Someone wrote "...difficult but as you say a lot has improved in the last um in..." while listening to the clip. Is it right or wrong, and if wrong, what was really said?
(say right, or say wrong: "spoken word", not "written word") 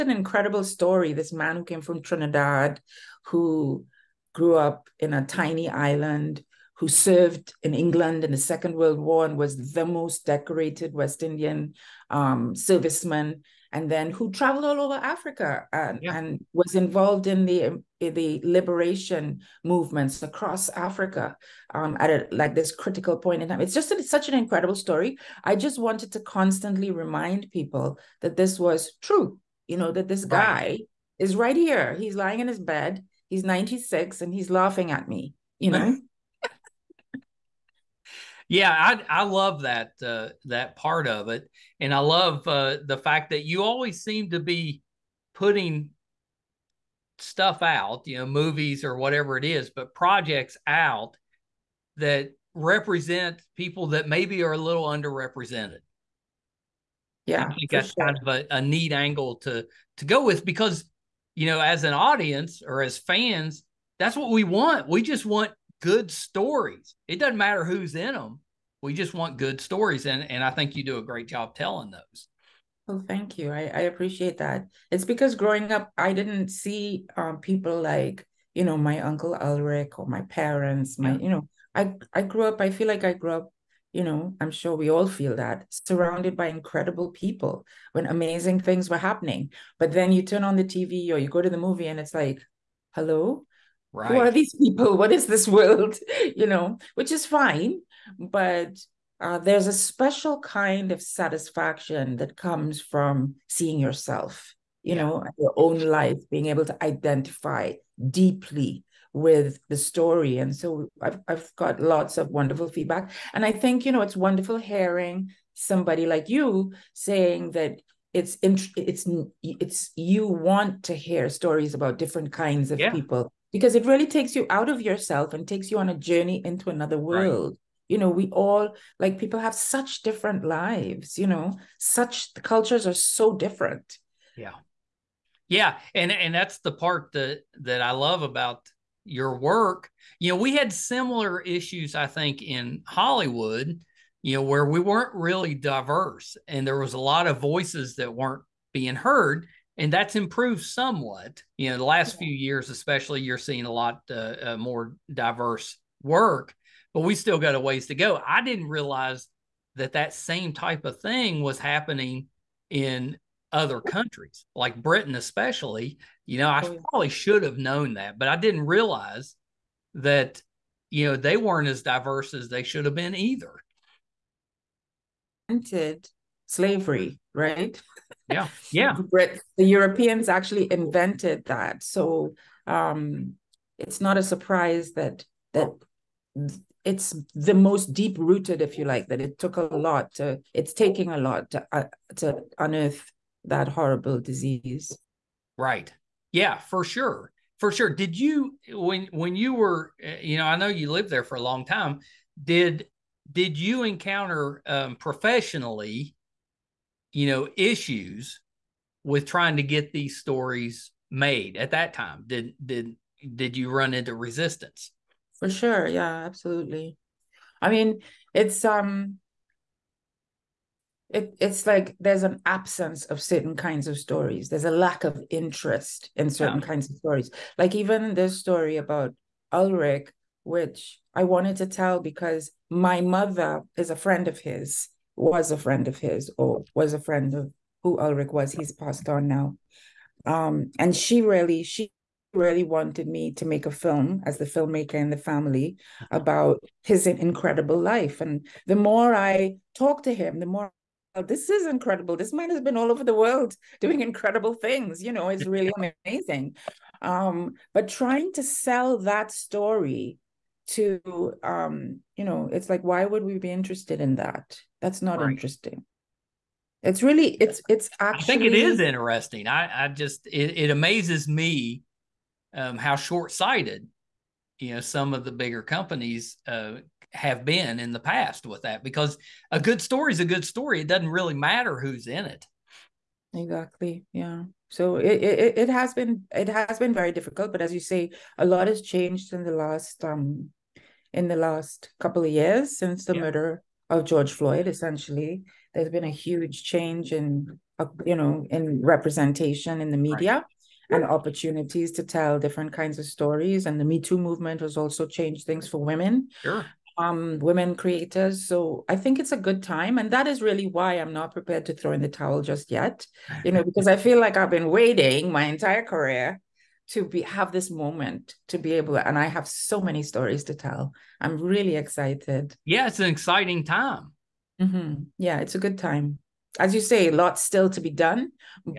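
wrong: "changed", not "improved".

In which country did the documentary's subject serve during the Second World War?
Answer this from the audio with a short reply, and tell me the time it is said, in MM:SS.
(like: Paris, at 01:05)
England, at 00:07.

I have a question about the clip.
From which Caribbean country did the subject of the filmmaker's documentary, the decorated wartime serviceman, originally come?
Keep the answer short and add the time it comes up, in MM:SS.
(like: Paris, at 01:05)
Trinidad, at 00:02.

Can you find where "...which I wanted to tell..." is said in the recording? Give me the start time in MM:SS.
03:50.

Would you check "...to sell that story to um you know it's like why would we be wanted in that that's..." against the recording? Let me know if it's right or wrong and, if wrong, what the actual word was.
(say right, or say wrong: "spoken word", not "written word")
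wrong: "interested", not "wanted".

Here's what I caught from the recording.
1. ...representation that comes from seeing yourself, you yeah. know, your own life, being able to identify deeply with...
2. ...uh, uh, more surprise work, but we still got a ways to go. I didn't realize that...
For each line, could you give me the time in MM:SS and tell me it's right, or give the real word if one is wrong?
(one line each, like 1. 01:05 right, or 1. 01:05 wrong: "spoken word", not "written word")
1. 01:41 wrong: "satisfaction", not "representation"
2. 02:34 wrong: "diverse", not "surprise".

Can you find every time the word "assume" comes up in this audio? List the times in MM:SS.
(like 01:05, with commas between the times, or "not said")
not said.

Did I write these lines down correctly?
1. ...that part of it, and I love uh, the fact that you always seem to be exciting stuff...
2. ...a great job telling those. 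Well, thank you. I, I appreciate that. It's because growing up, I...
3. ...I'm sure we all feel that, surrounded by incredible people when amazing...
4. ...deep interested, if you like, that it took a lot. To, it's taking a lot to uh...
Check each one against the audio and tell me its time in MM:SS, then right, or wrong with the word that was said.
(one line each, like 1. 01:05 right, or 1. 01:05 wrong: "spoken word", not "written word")
1. 00:40 wrong: "putting", not "exciting"
2. 01:10 right
3. 01:24 right
4. 03:07 wrong: "rooted", not "interested".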